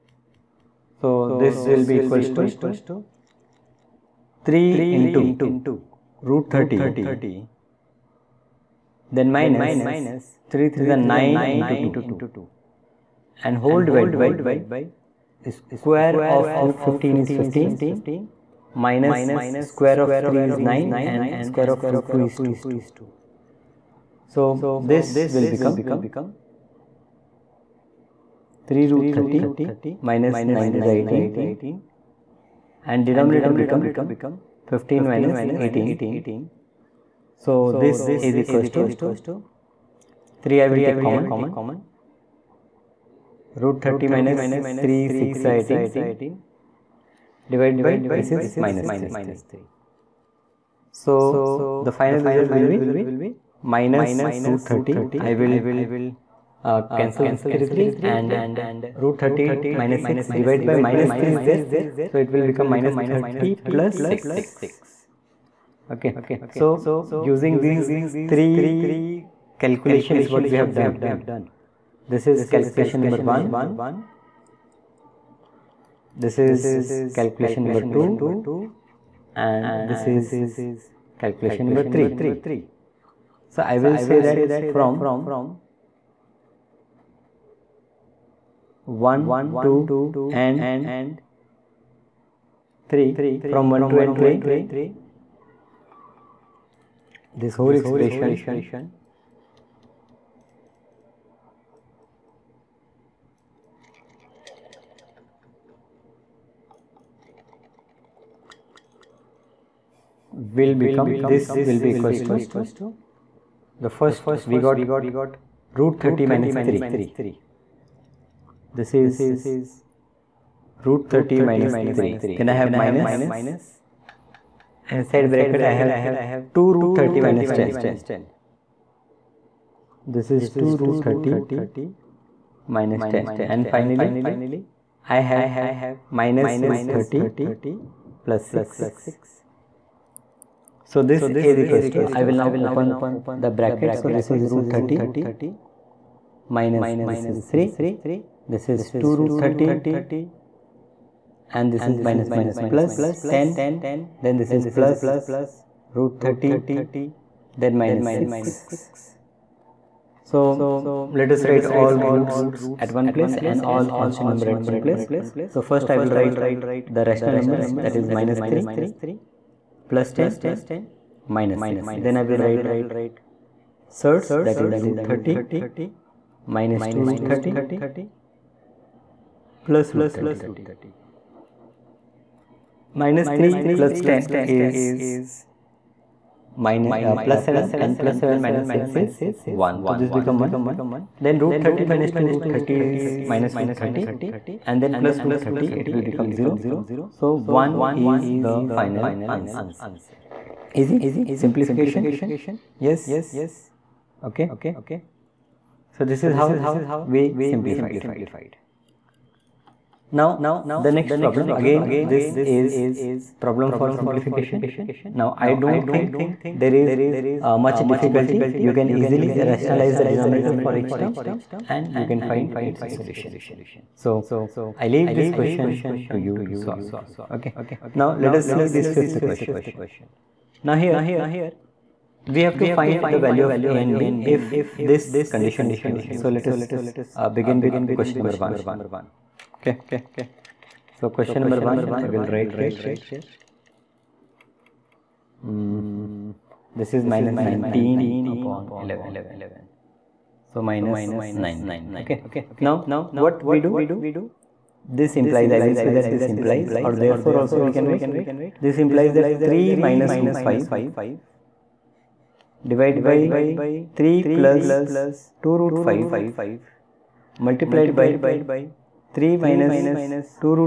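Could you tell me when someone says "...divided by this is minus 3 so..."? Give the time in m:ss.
0:47.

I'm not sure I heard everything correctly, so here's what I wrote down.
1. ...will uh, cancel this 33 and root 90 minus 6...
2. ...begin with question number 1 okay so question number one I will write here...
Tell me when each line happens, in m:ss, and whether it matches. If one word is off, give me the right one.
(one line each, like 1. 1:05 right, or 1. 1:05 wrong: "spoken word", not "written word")
1. 0:55 wrong: "30", not "90"
2. 3:57 right.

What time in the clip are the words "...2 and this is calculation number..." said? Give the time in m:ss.
1:17.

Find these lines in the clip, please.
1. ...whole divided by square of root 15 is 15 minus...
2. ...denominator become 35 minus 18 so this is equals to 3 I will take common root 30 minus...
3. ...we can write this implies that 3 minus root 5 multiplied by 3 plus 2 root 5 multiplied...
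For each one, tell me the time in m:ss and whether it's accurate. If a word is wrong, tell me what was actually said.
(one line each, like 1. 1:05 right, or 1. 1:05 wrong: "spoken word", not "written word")
1. 0:13 right
2. 0:33 wrong: "15", not "35"
3. 4:17 wrong: "divided", not "multiplied".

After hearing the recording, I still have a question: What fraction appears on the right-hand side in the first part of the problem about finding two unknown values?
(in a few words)
-19/11.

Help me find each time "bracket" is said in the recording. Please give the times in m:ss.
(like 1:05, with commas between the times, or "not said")
2:05, 2:23.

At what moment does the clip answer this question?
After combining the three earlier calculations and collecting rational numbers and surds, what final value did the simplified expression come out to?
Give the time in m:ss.
3:17.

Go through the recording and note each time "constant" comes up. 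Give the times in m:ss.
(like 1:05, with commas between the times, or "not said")
2:43.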